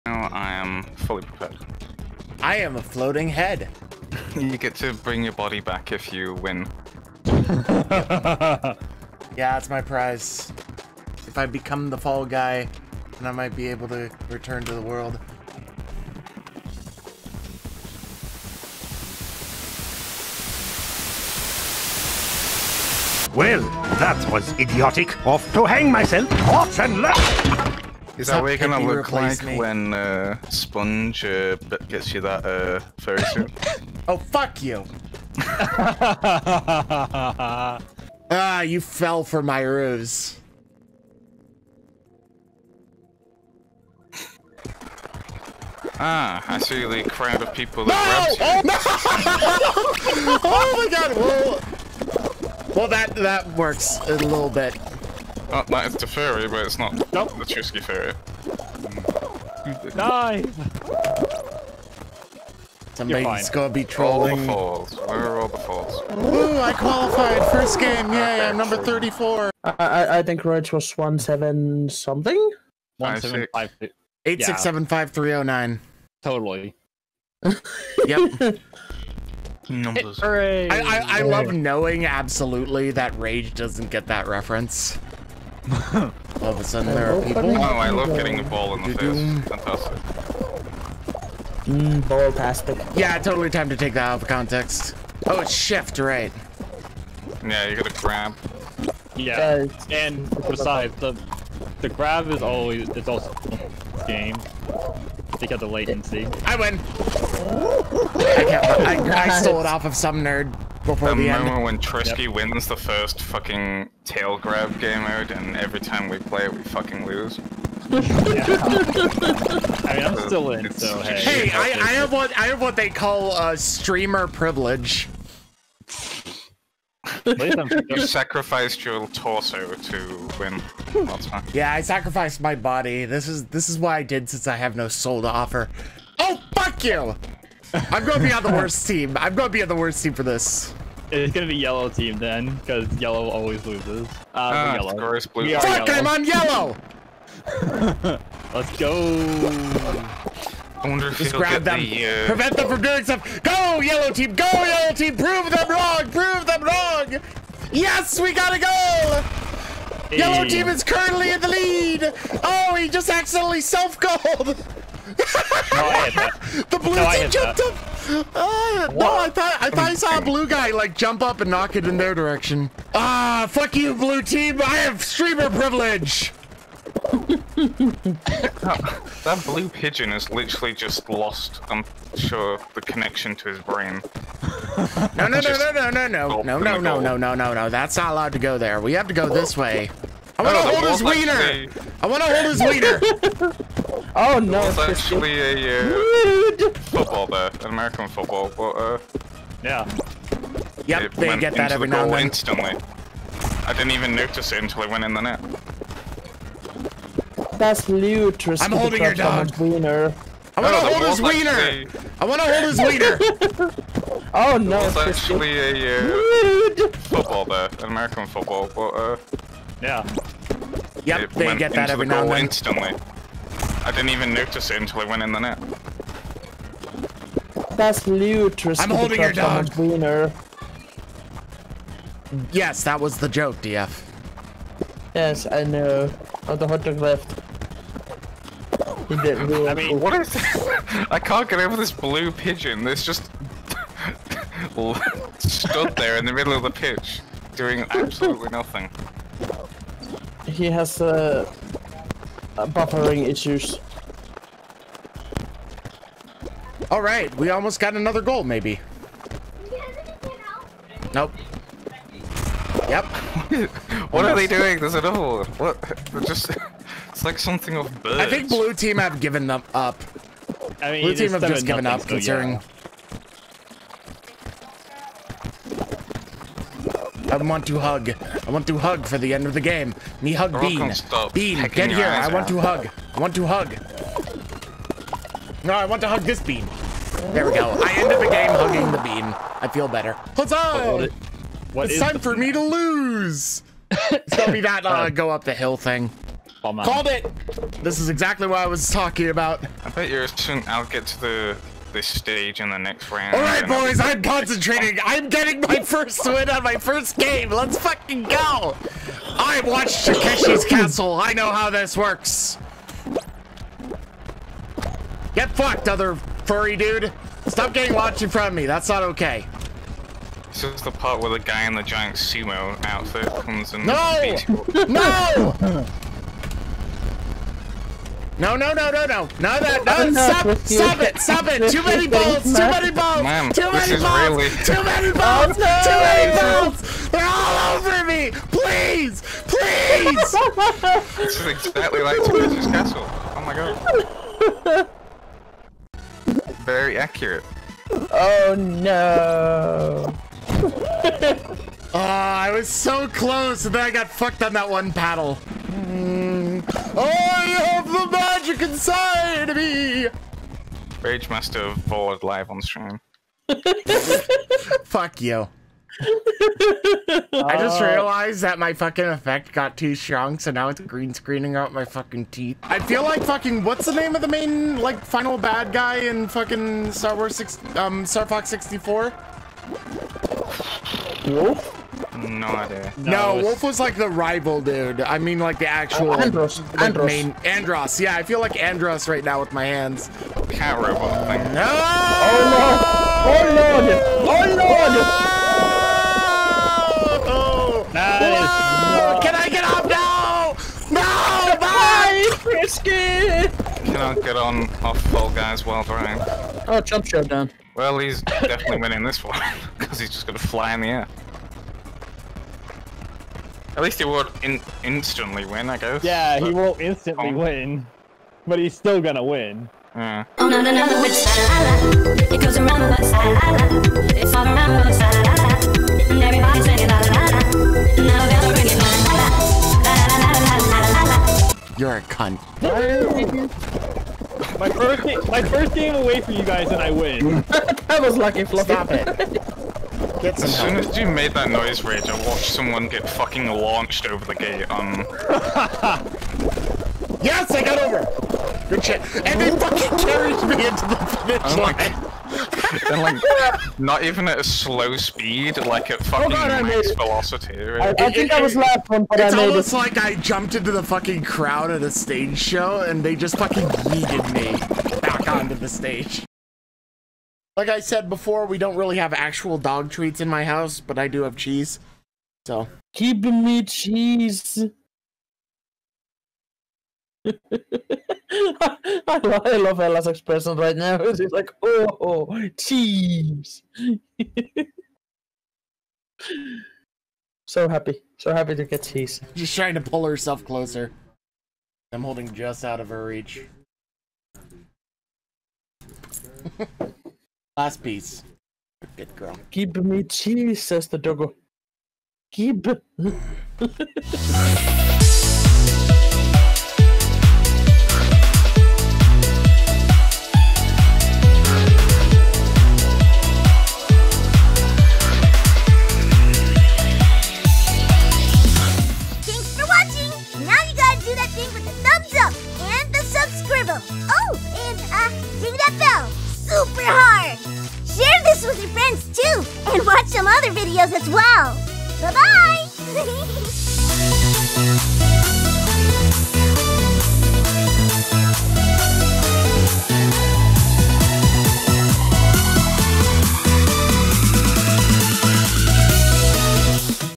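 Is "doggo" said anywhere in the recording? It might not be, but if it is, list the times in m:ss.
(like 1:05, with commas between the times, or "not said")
8:20.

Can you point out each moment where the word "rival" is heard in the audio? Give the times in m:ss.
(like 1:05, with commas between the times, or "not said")
6:24.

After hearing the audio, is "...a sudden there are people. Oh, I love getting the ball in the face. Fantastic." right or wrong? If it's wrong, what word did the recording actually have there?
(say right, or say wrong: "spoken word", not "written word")
right.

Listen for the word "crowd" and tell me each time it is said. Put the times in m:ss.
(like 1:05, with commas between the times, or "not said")
0:47, 7:41.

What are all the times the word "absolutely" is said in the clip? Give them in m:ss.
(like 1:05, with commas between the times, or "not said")
1:22, 4:07.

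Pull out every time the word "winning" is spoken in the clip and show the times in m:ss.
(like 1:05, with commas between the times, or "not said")
6:48.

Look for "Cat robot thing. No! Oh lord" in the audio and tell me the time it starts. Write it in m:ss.
6:30.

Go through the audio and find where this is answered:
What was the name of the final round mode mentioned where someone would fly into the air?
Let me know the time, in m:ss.
6:46.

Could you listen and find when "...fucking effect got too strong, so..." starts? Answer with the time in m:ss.
6:08.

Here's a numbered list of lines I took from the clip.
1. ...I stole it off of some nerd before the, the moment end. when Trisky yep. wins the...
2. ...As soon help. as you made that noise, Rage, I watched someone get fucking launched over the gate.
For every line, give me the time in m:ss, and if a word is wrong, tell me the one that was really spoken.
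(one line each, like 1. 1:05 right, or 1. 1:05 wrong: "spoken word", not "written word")
1. 1:49 right
2. 7:20 right.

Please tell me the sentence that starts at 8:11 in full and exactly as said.
I'm holding just out of her reach.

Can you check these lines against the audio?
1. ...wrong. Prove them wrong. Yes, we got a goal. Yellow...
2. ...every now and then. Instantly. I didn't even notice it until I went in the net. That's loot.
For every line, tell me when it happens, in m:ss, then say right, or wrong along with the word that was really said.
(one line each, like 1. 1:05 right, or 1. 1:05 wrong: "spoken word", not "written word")
1. 2:35 right
2. 3:41 right.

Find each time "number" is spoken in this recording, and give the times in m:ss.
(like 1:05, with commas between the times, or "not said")
1:08, 1:19.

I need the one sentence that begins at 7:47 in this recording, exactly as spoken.
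Like I said before, we don't really have actual dog treats in my house, but I do have cheese.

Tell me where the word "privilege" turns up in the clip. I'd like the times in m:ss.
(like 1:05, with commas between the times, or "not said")
2:04, 2:55.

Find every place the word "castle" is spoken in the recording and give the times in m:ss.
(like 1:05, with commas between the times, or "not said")
5:10, 5:42.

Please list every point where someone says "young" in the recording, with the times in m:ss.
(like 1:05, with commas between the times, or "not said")
not said.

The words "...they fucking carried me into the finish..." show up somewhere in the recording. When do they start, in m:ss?
7:29.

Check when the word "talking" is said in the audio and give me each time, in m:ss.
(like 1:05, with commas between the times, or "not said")
4:58.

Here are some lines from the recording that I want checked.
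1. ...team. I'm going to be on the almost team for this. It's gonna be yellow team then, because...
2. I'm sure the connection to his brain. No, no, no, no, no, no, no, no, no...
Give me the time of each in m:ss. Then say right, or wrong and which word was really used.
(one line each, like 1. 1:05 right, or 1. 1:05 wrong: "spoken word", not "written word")
1. 2:18 wrong: "worst", not "almost"
2. 3:01 right.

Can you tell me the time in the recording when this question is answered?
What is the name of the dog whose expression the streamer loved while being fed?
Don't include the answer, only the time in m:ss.
7:59.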